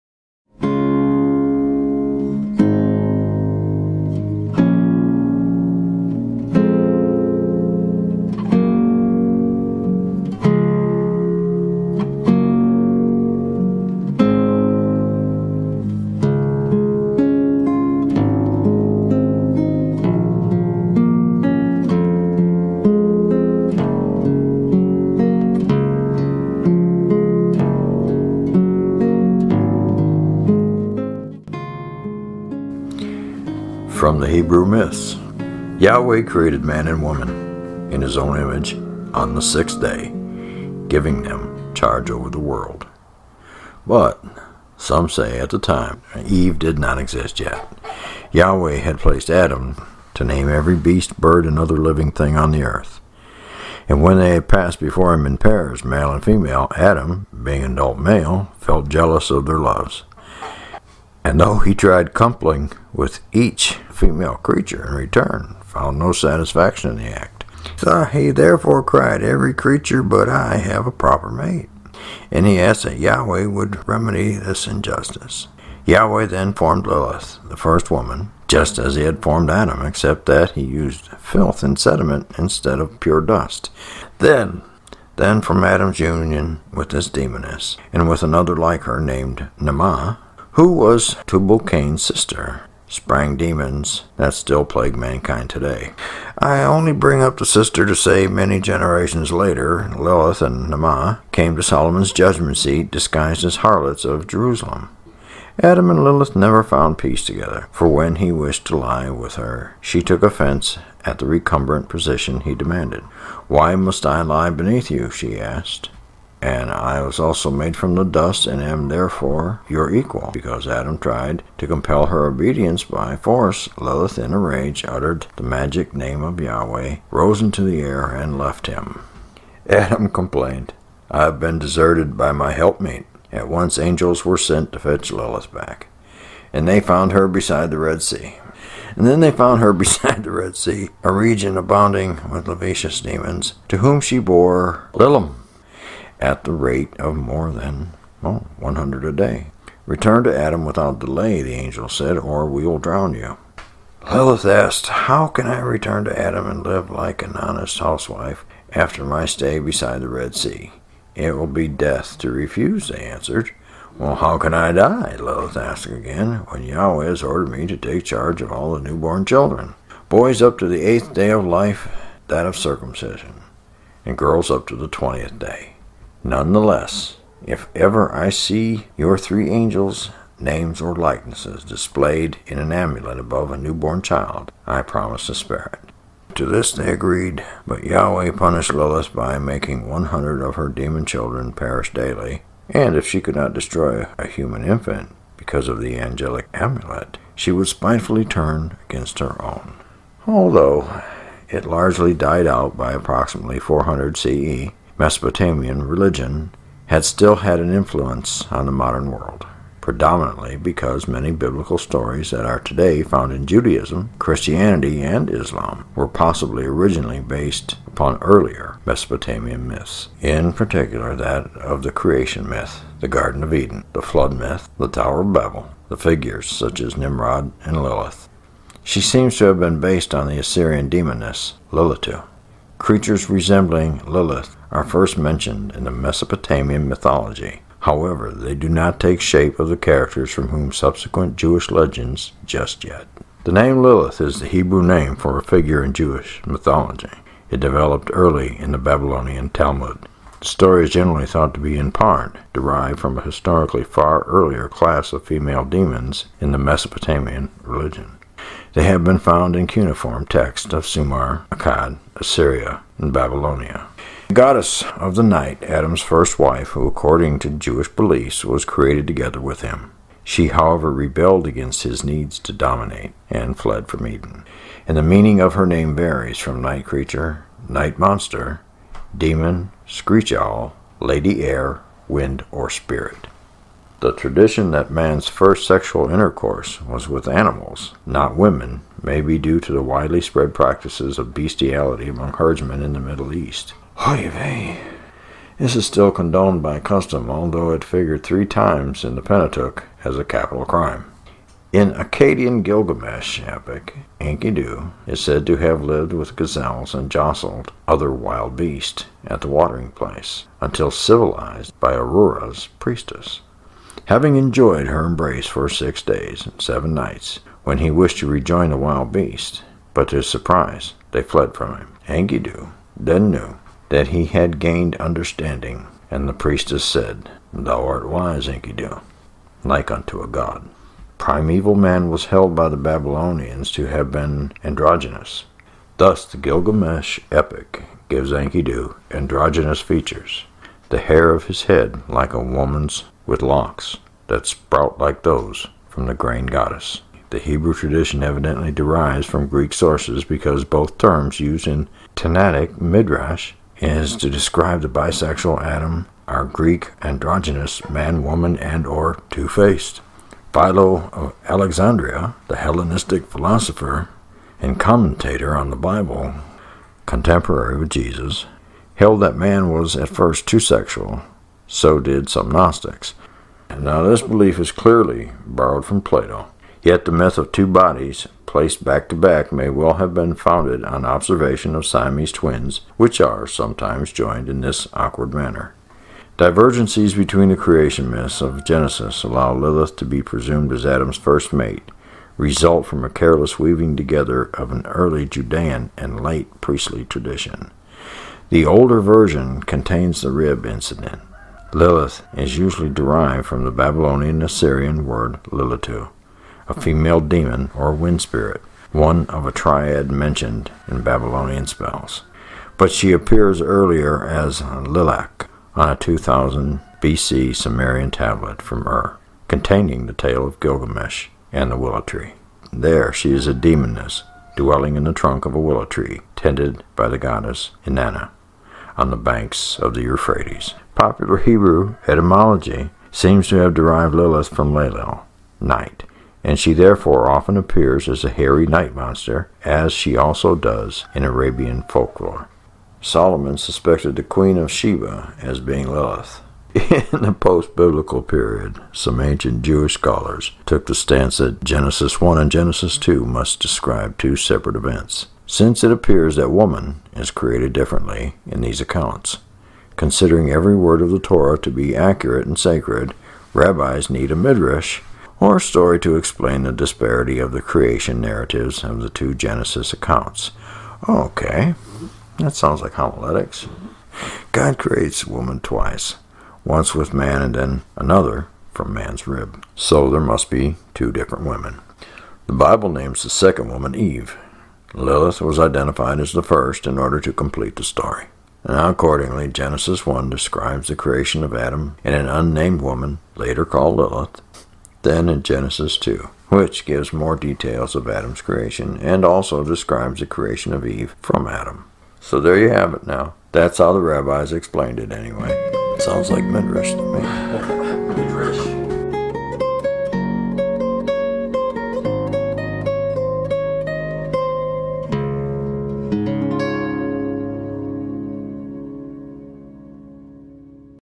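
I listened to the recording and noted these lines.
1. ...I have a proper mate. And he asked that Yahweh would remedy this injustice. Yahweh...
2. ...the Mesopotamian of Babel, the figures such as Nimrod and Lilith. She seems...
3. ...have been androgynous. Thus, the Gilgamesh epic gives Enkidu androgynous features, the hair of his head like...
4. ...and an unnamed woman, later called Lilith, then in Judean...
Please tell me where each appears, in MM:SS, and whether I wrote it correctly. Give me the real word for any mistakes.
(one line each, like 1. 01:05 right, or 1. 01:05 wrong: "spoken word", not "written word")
1. 01:10 right
2. 03:44 wrong: "Tower", not "Mesopotamian"
3. 05:33 right
4. 08:12 wrong: "Genesis", not "Judean".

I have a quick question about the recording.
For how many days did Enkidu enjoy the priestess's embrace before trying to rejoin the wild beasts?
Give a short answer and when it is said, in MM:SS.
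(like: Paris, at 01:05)
6, at 05:15.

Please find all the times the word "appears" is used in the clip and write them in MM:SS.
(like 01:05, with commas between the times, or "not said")
06:53, 07:17, 07:35.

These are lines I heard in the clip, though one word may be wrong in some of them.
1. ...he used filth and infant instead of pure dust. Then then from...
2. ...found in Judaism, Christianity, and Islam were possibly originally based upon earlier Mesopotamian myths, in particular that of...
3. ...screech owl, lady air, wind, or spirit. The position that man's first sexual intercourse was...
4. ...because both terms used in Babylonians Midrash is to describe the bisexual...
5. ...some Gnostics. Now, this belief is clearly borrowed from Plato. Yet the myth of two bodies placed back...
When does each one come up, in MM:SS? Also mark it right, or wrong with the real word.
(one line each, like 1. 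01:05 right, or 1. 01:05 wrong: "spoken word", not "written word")
1. 01:20 wrong: "sediment", not "infant"
2. 03:33 right
3. 04:39 wrong: "tradition", not "position"
4. 05:50 wrong: "Tanaic", not "Babylonians"
5. 06:12 right.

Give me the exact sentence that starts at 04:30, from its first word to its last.
She, however, rebelled against his needs to dominate and fled from Eden.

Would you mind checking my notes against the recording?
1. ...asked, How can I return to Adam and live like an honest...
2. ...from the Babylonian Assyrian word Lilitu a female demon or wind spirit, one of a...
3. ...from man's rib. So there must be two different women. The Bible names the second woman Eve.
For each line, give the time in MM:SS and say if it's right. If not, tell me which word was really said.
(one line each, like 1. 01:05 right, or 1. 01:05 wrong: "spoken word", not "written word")
1. 02:34 right
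2. 06:43 right
3. 07:58 right.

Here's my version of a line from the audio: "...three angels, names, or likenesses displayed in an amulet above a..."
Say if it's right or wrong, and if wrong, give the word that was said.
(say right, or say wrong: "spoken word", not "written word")
right.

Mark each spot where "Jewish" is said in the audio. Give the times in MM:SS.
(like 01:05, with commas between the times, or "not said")
04:01, 04:05, 04:27, 07:29.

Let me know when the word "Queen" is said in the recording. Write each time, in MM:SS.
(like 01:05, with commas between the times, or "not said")
07:24.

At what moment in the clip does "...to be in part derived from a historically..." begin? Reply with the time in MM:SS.
04:11.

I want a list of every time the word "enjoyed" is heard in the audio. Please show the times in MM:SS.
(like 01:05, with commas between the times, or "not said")
05:14.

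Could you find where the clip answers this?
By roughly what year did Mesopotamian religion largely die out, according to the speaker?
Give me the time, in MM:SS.
03:23.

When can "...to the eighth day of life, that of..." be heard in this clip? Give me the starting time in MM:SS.
02:50.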